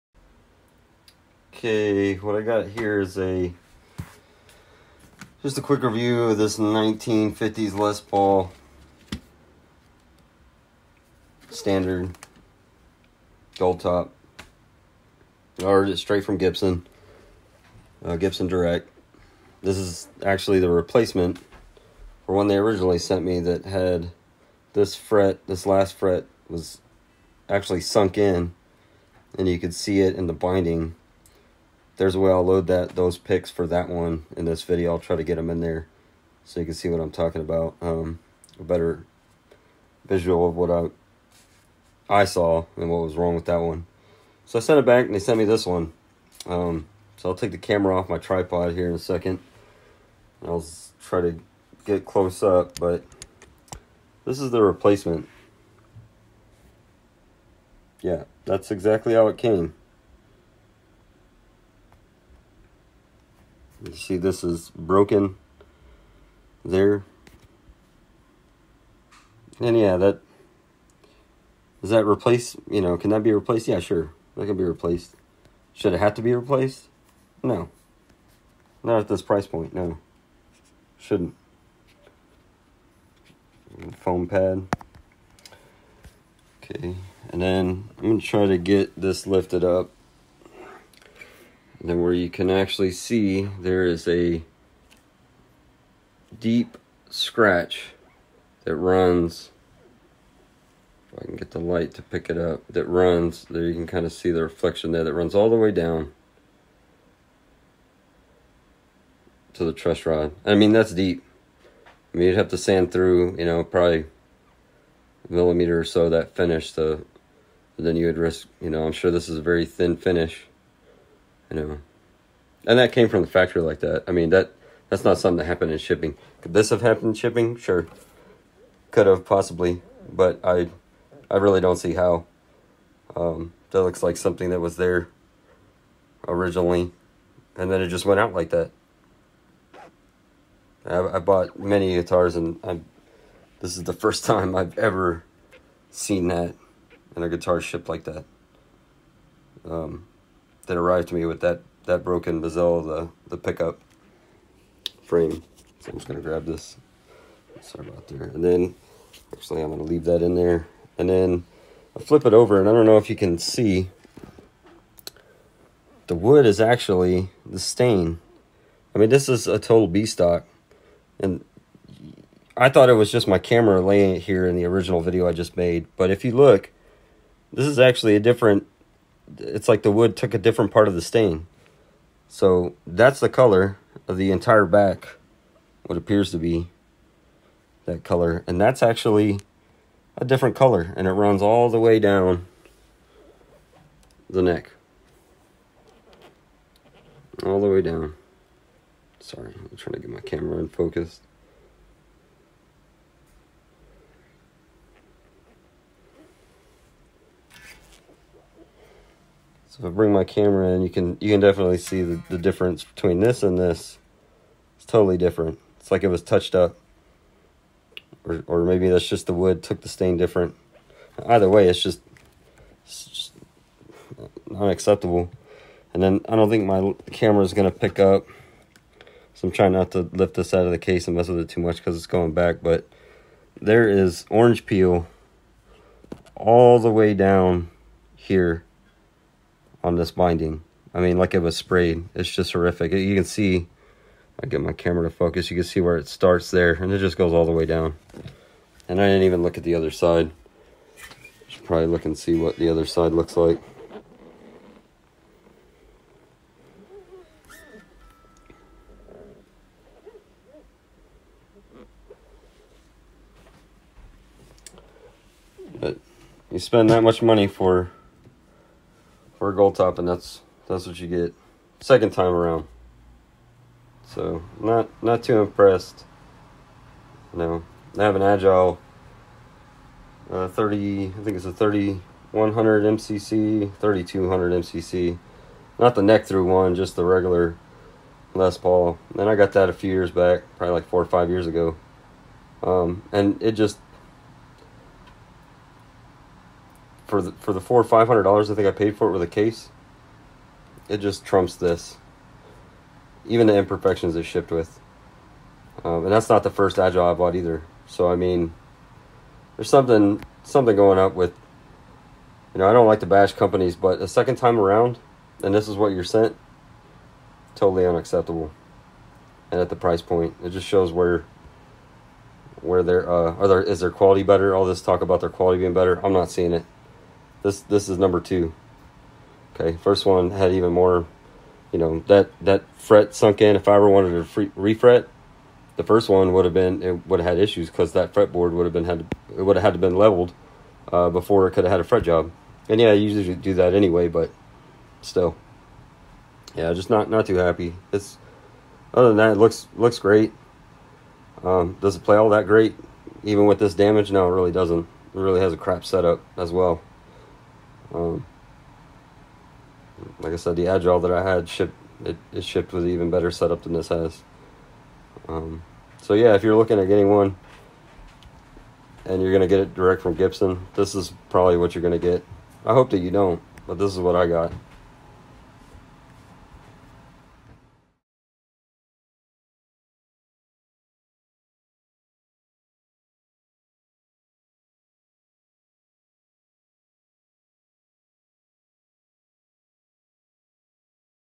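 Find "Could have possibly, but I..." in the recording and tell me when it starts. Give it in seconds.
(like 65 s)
128 s.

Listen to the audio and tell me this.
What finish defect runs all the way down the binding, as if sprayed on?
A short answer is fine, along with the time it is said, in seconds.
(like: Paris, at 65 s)
orange peel, at 234 s.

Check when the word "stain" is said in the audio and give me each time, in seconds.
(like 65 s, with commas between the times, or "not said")
167 s, 181 s, 219 s.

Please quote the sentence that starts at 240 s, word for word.
I mean, like it was sprayed.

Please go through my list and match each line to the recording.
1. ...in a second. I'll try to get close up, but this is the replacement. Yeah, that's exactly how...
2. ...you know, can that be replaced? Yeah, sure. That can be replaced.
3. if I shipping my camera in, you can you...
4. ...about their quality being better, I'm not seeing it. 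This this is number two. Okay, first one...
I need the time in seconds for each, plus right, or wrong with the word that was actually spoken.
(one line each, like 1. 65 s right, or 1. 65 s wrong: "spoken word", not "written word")
1. 48 s right
2. 72 s right
3. 209 s wrong: "bring", not "shipping"
4. 325 s right.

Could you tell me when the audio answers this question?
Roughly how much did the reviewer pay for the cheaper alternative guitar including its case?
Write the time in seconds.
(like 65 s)
297 s.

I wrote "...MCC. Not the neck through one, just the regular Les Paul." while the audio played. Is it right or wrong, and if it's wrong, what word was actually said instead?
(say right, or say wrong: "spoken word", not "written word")
right.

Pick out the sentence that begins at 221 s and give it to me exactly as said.
Either way, it's just, it's just And then I don't think my camera is going to pick up.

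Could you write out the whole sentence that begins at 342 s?
And yeah, I usually do that anyway, but still, yeah, just not not too happy.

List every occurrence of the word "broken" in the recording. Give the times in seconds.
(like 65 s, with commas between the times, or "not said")
64 s, 152 s.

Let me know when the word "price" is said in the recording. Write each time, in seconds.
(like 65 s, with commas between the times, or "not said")
79 s, 319 s.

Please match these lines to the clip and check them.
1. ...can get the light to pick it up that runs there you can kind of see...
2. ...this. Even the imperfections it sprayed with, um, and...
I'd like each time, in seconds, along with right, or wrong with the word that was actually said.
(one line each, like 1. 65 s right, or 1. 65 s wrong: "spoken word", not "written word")
1. 101 s right
2. 301 s wrong: "shipped", not "sprayed".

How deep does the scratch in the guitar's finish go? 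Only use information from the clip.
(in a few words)
truss rod.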